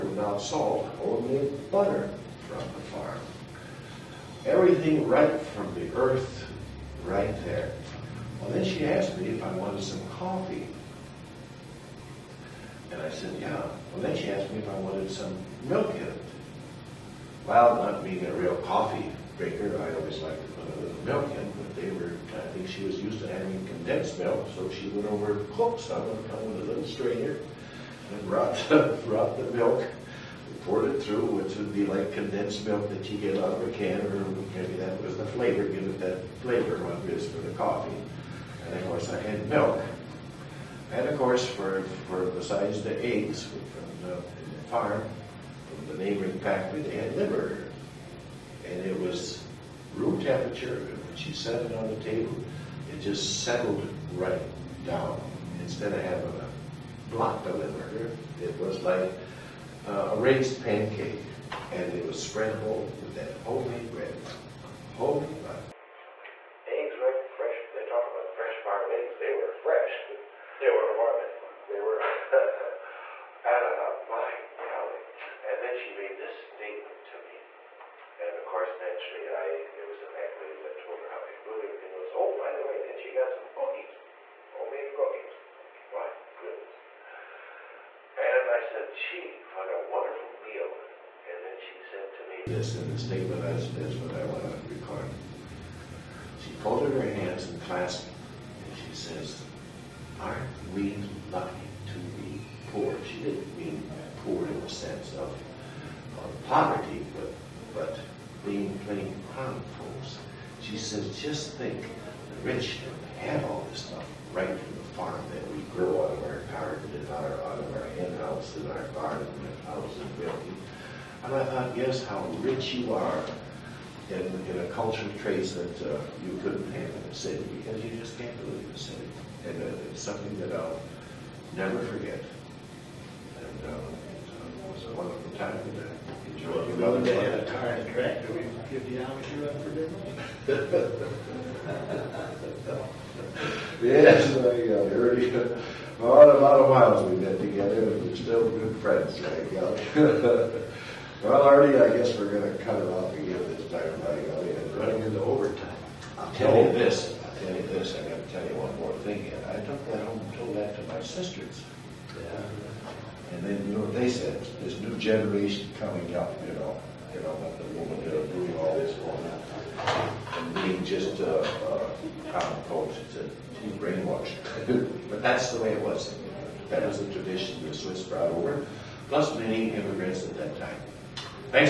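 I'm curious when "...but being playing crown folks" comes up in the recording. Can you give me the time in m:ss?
1:47.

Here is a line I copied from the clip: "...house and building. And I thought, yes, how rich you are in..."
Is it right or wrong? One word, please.
right.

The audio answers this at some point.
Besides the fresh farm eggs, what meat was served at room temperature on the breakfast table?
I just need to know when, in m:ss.
0:47.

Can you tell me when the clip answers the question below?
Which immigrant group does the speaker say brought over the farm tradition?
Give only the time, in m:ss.
2:57.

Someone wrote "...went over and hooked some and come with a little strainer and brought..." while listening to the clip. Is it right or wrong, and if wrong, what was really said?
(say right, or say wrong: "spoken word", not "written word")
right.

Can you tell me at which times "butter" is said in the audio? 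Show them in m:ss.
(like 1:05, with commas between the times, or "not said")
0:01, 1:05.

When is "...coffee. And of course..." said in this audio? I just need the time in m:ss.
0:37.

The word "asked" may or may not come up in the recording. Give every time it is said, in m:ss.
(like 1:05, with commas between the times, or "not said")
0:08, 0:14.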